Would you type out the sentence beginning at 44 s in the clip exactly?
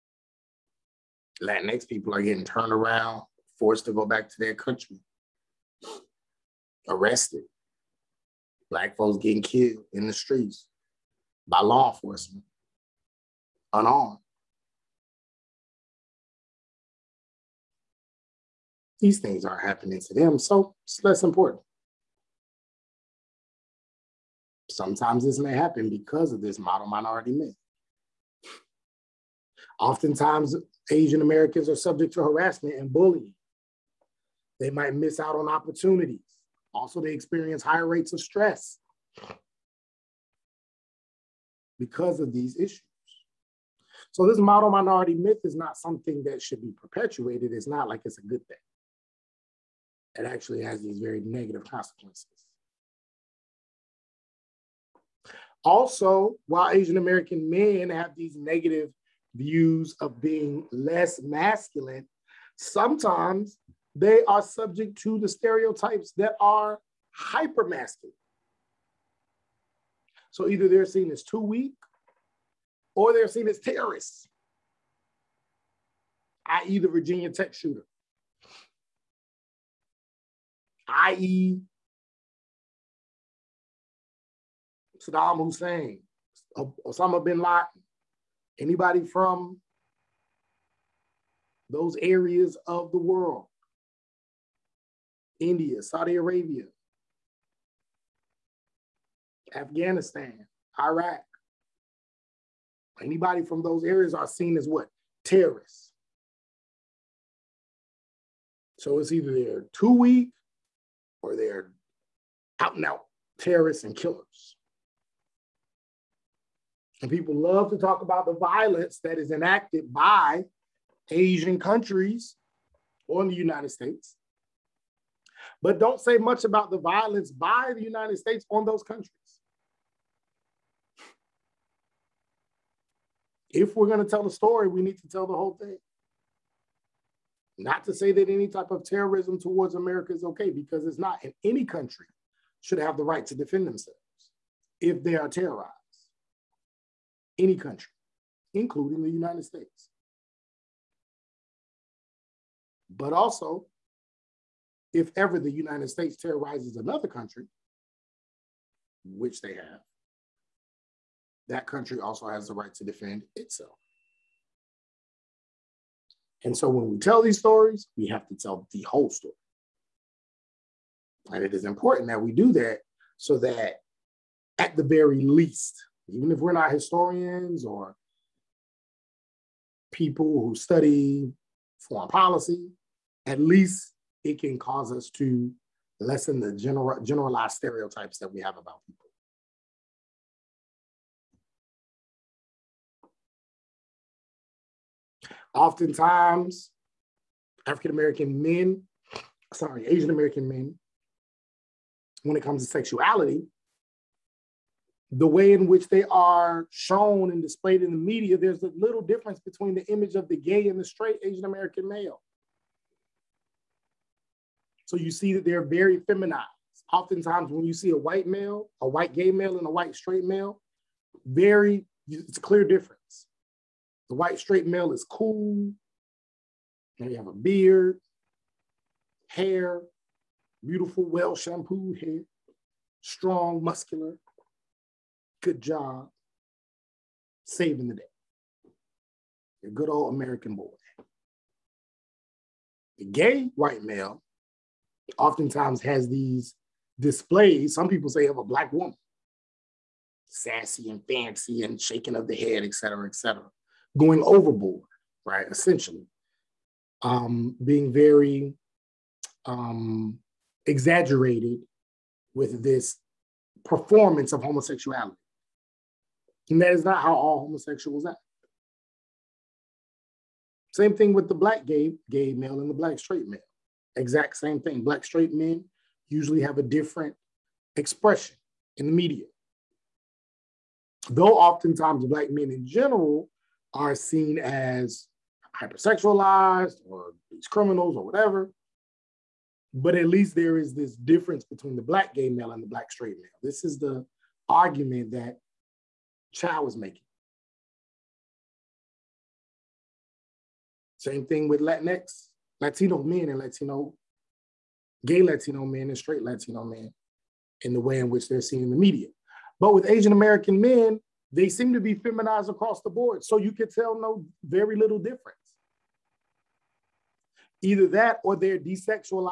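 So, this model minority myth is not something that should be perpetuated.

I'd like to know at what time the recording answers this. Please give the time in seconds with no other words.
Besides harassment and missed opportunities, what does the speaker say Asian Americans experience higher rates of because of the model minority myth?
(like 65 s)
38 s.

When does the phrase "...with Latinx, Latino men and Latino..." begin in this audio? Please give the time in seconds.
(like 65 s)
301 s.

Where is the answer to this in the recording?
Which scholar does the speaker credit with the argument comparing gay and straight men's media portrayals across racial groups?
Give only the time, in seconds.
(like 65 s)
296 s.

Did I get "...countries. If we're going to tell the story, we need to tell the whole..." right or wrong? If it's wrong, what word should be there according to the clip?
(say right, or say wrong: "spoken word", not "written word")
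right.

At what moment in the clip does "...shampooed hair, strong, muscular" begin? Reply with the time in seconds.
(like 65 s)
231 s.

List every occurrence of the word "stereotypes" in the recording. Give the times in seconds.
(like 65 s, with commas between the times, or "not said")
65 s, 187 s.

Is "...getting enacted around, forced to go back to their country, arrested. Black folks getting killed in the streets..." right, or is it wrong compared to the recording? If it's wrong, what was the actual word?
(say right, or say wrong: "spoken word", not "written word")
wrong: "turned", not "enacted".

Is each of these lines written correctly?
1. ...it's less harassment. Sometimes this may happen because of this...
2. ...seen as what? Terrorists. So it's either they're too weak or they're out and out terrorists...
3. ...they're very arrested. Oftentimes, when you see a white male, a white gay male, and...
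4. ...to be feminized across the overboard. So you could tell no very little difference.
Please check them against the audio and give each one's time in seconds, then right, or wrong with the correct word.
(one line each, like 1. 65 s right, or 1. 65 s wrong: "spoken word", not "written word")
1. 20 s wrong: "important", not "harassment"
2. 104 s right
3. 215 s wrong: "feminized", not "arrested"
4. 311 s wrong: "board", not "overboard".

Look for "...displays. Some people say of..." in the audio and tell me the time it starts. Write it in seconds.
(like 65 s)
246 s.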